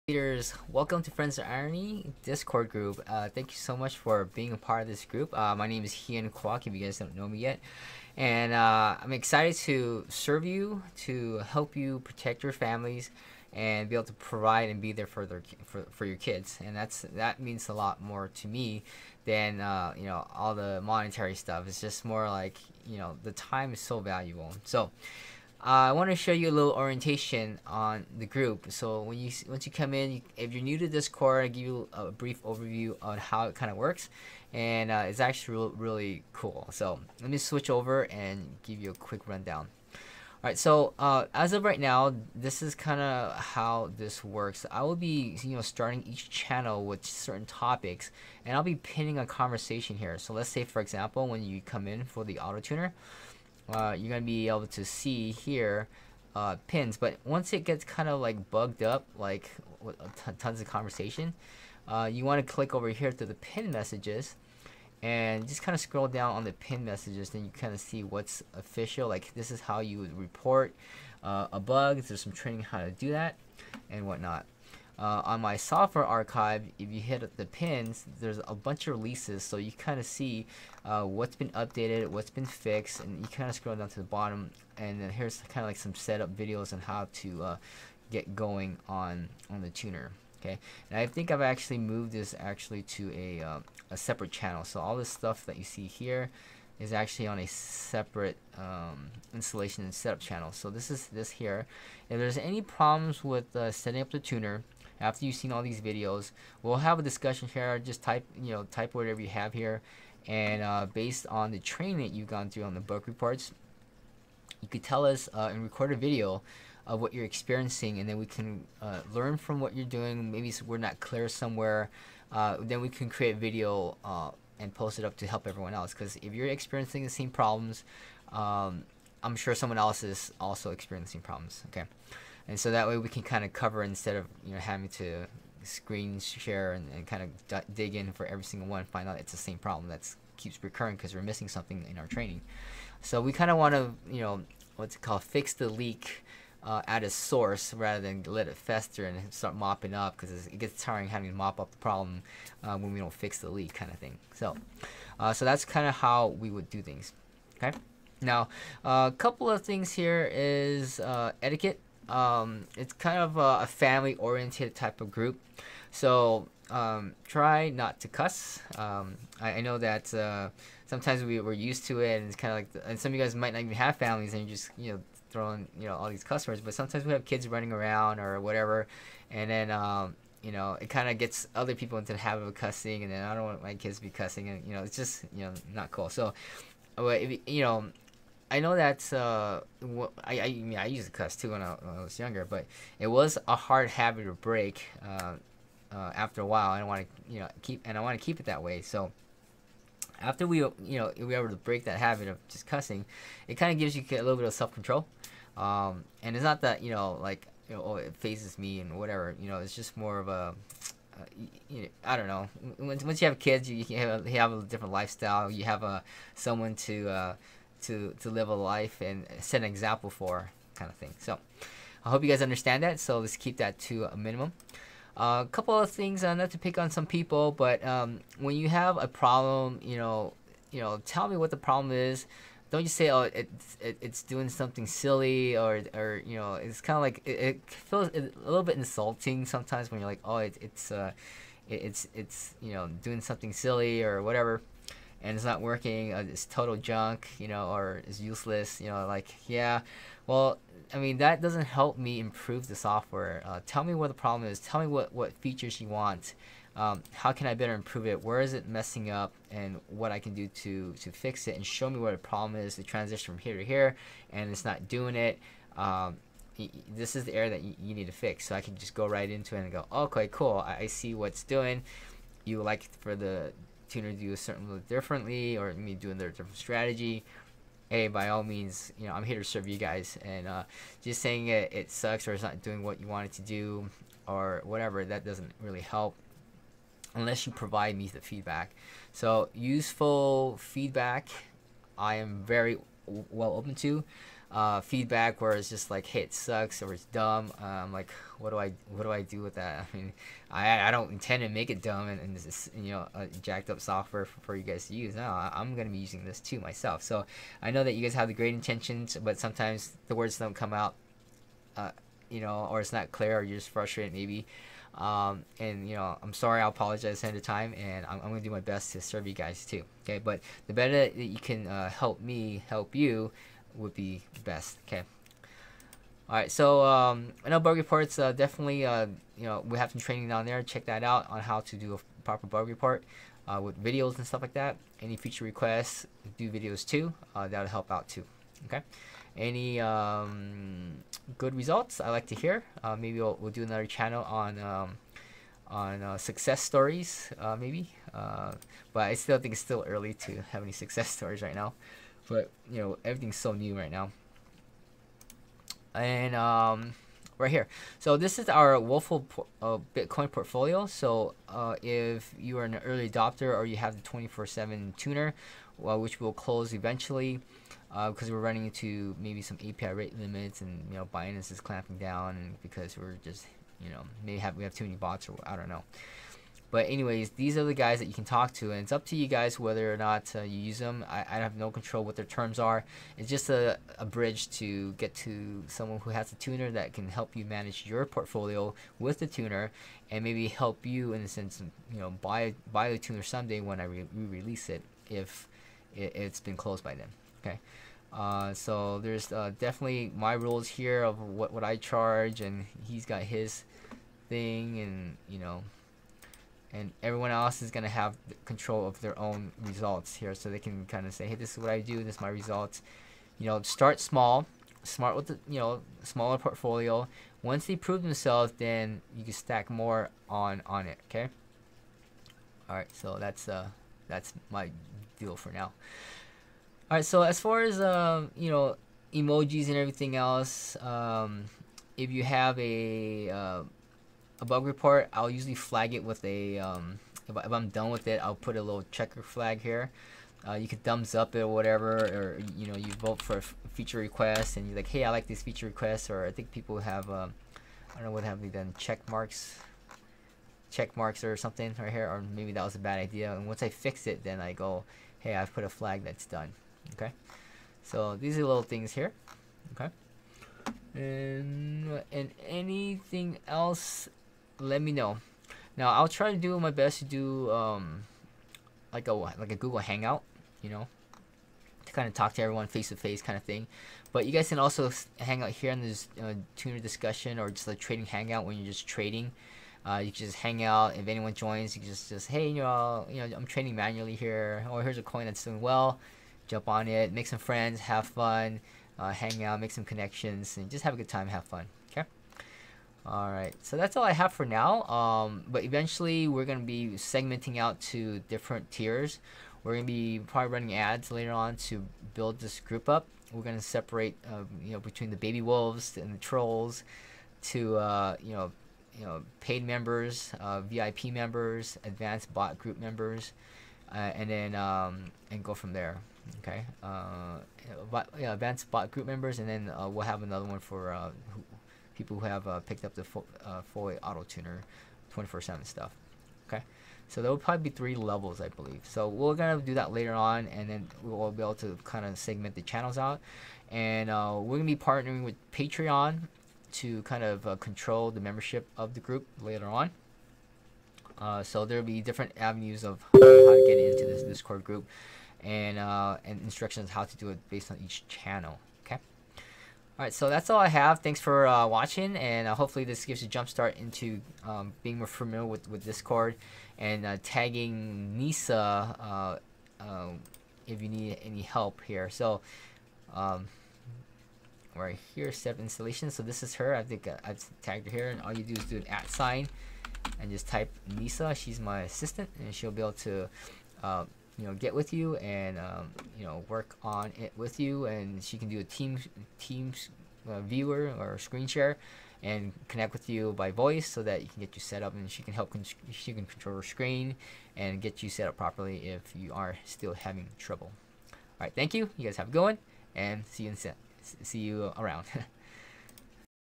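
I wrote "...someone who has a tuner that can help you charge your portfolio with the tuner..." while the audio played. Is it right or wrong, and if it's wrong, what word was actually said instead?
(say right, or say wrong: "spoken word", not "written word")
wrong: "manage", not "charge".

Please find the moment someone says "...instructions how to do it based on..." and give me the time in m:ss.
9:06.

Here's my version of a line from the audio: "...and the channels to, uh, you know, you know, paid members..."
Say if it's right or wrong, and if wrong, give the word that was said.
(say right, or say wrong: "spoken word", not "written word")
wrong: "trolls", not "channels".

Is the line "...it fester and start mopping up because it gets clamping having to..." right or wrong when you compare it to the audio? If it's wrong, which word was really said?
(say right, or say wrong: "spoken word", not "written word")
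wrong: "tiring", not "clamping".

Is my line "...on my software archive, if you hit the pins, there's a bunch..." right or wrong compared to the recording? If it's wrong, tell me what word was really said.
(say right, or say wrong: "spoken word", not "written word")
right.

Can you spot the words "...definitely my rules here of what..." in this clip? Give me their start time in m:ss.
6:39.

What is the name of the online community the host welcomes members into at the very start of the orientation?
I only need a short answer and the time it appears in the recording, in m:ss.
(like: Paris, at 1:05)
Friends of Irony, at 0:01.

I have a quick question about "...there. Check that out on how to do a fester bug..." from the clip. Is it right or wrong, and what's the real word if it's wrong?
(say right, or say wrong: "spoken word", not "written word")
wrong: "proper", not "fester".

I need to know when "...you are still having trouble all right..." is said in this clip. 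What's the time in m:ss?
9:49.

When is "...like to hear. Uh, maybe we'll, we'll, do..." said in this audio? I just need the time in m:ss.
5:42.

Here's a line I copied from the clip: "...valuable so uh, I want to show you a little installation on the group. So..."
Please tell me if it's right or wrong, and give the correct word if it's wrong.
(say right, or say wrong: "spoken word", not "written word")
wrong: "orientation", not "installation".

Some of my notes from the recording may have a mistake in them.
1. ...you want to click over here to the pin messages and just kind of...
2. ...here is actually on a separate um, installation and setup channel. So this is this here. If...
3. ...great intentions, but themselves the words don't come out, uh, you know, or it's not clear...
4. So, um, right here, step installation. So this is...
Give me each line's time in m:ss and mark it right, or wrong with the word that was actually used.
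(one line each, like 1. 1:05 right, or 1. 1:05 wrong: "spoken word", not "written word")
1. 1:02 right
2. 1:35 right
3. 5:08 wrong: "sometimes", not "themselves"
4. 9:22 right.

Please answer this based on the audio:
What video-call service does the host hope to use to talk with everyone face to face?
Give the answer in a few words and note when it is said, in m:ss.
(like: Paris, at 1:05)
Google Hangout, at 7:49.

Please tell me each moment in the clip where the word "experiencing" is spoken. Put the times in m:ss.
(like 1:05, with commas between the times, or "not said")
1:57, 2:06, 2:10.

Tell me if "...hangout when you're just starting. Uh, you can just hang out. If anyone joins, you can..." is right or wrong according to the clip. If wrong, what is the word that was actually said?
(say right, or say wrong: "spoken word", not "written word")
wrong: "trading", not "starting".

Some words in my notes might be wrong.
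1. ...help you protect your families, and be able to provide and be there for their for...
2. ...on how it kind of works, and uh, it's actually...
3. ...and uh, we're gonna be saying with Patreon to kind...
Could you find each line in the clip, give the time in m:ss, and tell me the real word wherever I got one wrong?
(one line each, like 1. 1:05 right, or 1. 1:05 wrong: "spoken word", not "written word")
1. 0:11 right
2. 0:32 right
3. 8:53 wrong: "partnering", not "saying".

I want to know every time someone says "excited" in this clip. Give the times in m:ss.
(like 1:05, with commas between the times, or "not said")
0:09.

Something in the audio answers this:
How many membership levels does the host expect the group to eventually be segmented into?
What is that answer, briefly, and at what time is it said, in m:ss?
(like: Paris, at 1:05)
3, at 8:47.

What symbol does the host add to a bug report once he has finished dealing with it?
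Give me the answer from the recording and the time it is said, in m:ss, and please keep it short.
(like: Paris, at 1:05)
checker flag, at 7:18.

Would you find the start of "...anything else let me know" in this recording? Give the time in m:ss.
7:42.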